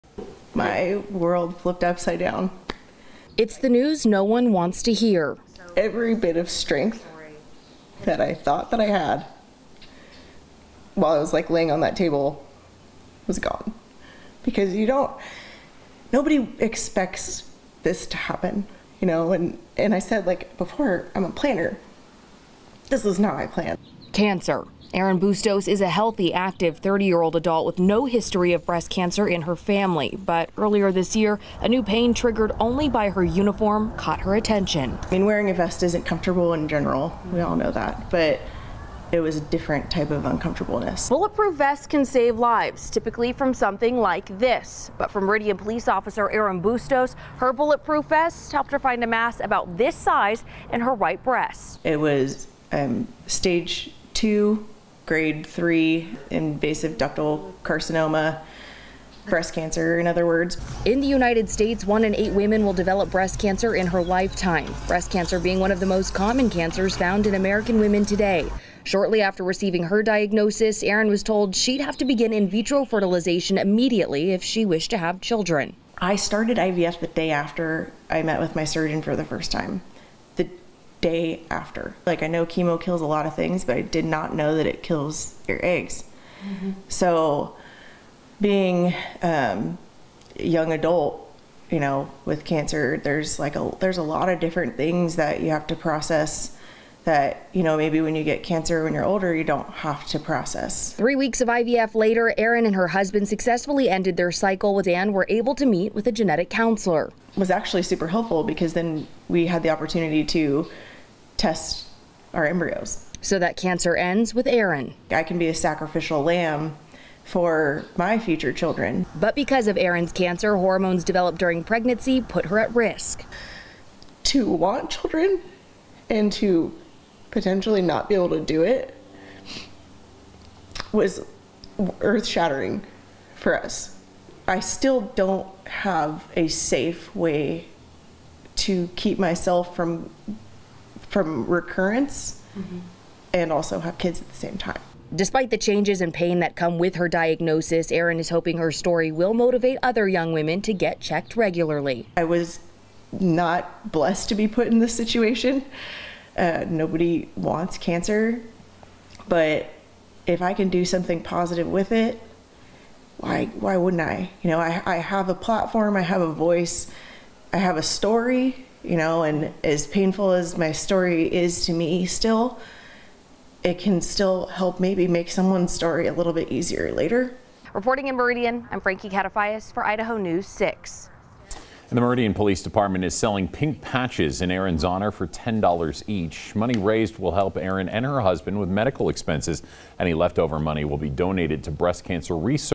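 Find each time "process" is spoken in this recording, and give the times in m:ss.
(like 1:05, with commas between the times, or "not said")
1:35, 1:40.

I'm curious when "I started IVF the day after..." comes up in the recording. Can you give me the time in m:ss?
1:15.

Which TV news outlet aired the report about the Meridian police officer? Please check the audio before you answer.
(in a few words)
Idaho News 6.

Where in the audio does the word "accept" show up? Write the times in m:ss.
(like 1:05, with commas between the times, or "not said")
not said.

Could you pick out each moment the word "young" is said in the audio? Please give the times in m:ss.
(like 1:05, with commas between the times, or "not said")
1:30, 2:30.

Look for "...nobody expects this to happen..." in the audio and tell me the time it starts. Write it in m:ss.
0:16.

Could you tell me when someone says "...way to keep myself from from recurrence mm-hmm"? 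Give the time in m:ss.
2:17.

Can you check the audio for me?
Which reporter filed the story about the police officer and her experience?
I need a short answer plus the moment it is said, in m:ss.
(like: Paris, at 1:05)
Frankie Catafias, at 2:58.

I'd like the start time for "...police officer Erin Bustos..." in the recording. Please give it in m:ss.
0:45.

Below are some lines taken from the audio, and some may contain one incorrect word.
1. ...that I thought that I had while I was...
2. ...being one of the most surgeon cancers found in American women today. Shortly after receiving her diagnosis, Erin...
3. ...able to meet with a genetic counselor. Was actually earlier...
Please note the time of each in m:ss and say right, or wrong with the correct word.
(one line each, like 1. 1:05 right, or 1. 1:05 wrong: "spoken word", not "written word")
1. 0:08 right
2. 1:05 wrong: "common", not "surgeon"
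3. 1:45 wrong: "super", not "earlier".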